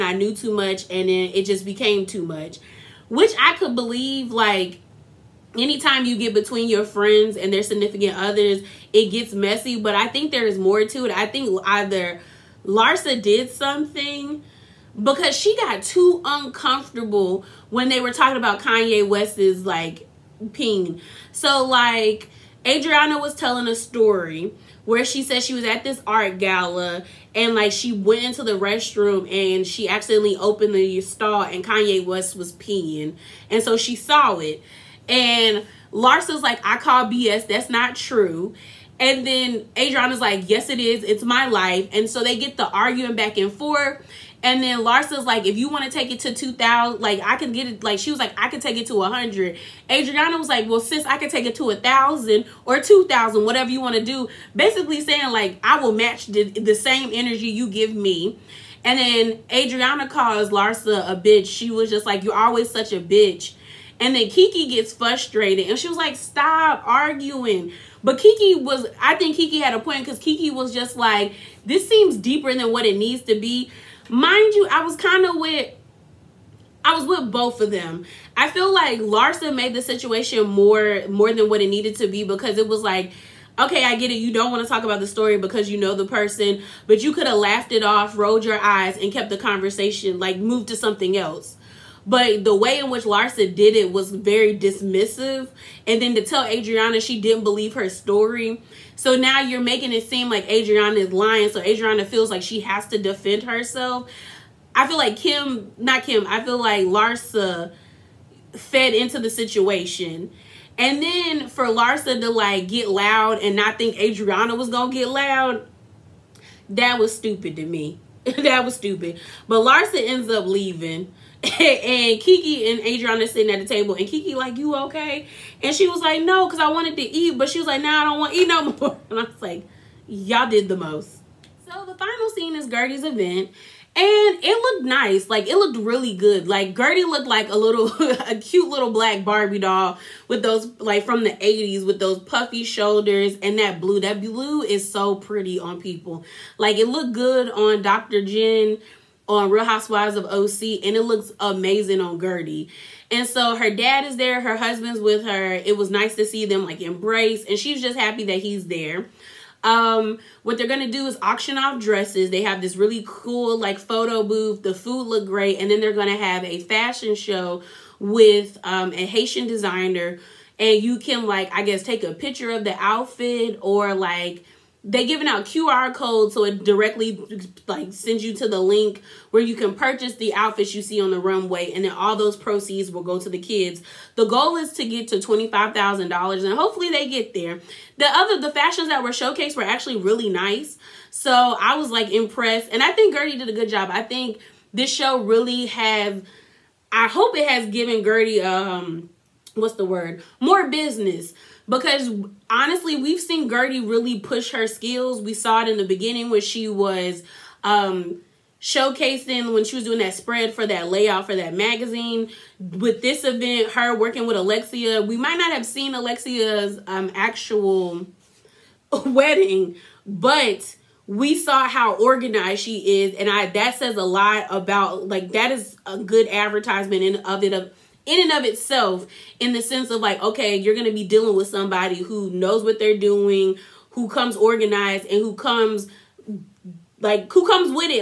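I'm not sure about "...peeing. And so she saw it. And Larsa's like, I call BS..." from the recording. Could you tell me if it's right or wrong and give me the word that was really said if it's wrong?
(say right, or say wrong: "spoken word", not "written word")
right.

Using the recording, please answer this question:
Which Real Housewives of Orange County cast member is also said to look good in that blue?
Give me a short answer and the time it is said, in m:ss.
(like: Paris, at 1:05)
Dr. Jen, at 2:27.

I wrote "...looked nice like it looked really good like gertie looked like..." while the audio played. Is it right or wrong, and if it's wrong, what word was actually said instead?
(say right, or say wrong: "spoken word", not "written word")
right.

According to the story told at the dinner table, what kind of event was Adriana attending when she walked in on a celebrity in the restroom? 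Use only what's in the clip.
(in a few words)
art gala.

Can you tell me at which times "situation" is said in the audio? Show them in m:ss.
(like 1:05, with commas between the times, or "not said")
1:19, 1:49.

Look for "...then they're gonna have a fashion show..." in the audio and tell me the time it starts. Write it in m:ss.
2:45.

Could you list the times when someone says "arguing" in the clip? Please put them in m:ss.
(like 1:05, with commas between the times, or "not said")
0:42, 1:06.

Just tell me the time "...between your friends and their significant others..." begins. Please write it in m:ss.
0:06.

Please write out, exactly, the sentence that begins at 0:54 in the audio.
Basically saying like, I will match the, the same energy you give me.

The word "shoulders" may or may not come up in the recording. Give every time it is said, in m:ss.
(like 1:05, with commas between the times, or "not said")
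2:22.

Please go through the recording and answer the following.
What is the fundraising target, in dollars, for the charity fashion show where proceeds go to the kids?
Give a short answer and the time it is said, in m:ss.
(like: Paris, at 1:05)
$25,000, at 3:05.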